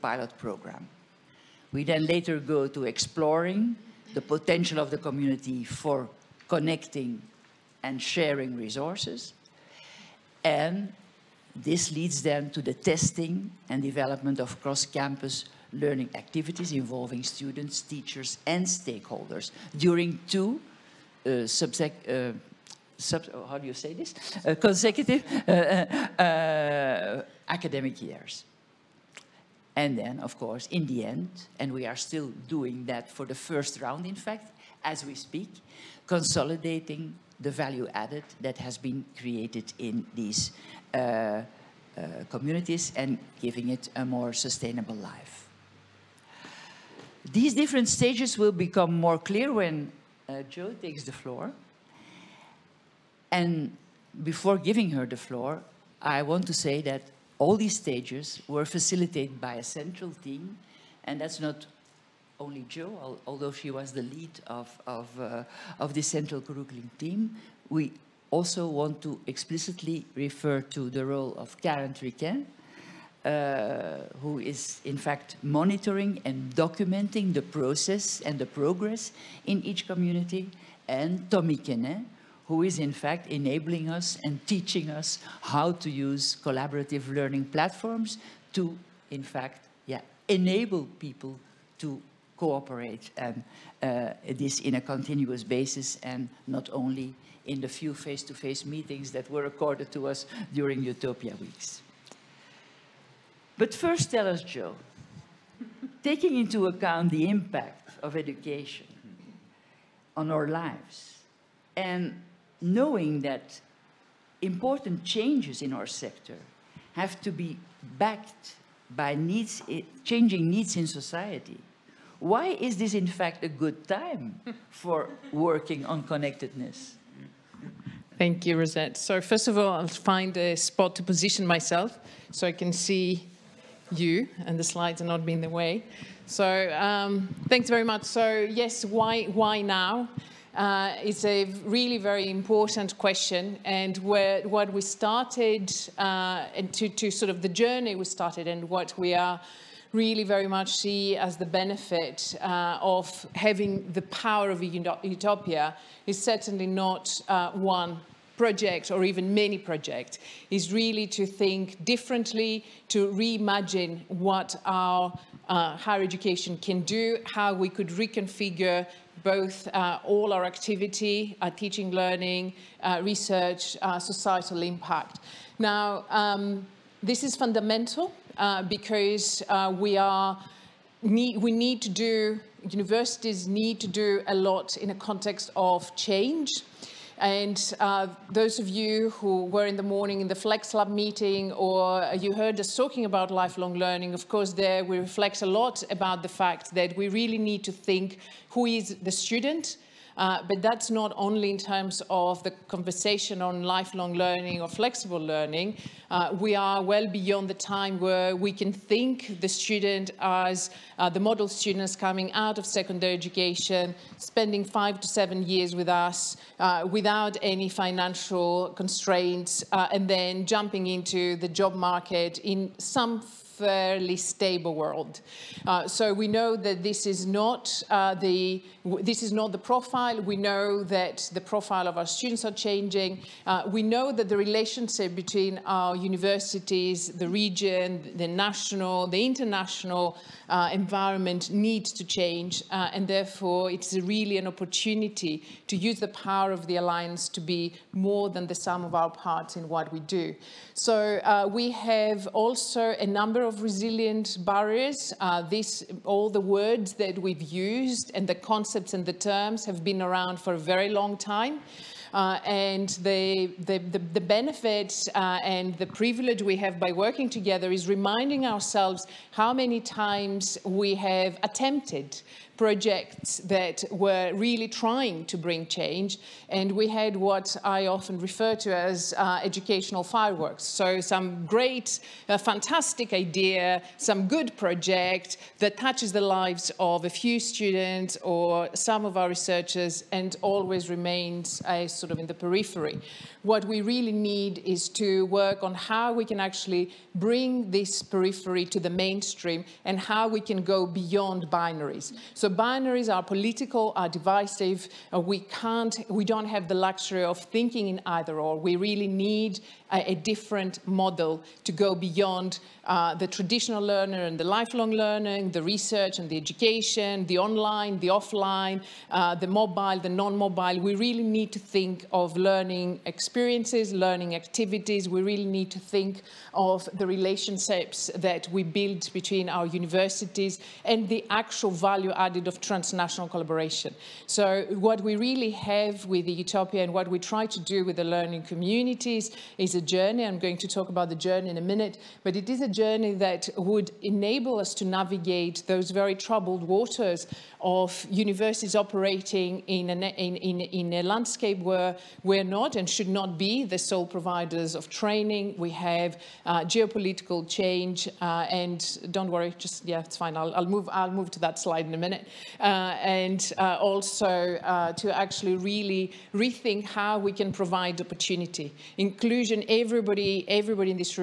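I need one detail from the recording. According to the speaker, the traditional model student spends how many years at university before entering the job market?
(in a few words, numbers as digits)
5 to 7.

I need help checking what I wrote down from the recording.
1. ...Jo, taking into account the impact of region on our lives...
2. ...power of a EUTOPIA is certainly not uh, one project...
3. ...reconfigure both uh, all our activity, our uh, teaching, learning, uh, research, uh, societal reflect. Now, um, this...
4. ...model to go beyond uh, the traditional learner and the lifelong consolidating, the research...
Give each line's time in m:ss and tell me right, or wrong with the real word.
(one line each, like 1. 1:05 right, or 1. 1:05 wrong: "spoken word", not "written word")
1. 1:44 wrong: "education", not "region"
2. 2:34 right
3. 2:47 wrong: "impact", not "reflect"
4. 5:10 wrong: "learning", not "consolidating".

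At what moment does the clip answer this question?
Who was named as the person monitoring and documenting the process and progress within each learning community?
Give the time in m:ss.
1:11.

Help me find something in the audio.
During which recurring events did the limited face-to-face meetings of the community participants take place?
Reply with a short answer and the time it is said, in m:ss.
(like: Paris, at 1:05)
EUTOPIA Weeks, at 1:40.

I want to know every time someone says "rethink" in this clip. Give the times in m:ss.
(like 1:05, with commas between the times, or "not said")
6:06.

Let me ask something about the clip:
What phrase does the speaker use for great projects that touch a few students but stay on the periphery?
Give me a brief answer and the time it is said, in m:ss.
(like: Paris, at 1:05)
educational fireworks, at 4:39.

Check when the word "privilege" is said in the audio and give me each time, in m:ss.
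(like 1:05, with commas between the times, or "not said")
4:25.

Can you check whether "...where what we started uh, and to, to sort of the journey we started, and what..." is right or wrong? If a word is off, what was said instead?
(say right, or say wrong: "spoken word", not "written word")
right.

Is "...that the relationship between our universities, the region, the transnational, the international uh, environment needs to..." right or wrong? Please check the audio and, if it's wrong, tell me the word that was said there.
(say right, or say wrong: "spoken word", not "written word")
wrong: "national", not "transnational".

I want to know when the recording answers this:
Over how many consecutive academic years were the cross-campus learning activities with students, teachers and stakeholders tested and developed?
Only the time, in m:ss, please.
0:20.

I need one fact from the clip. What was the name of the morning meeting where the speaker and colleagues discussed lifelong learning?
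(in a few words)
Flex Lab.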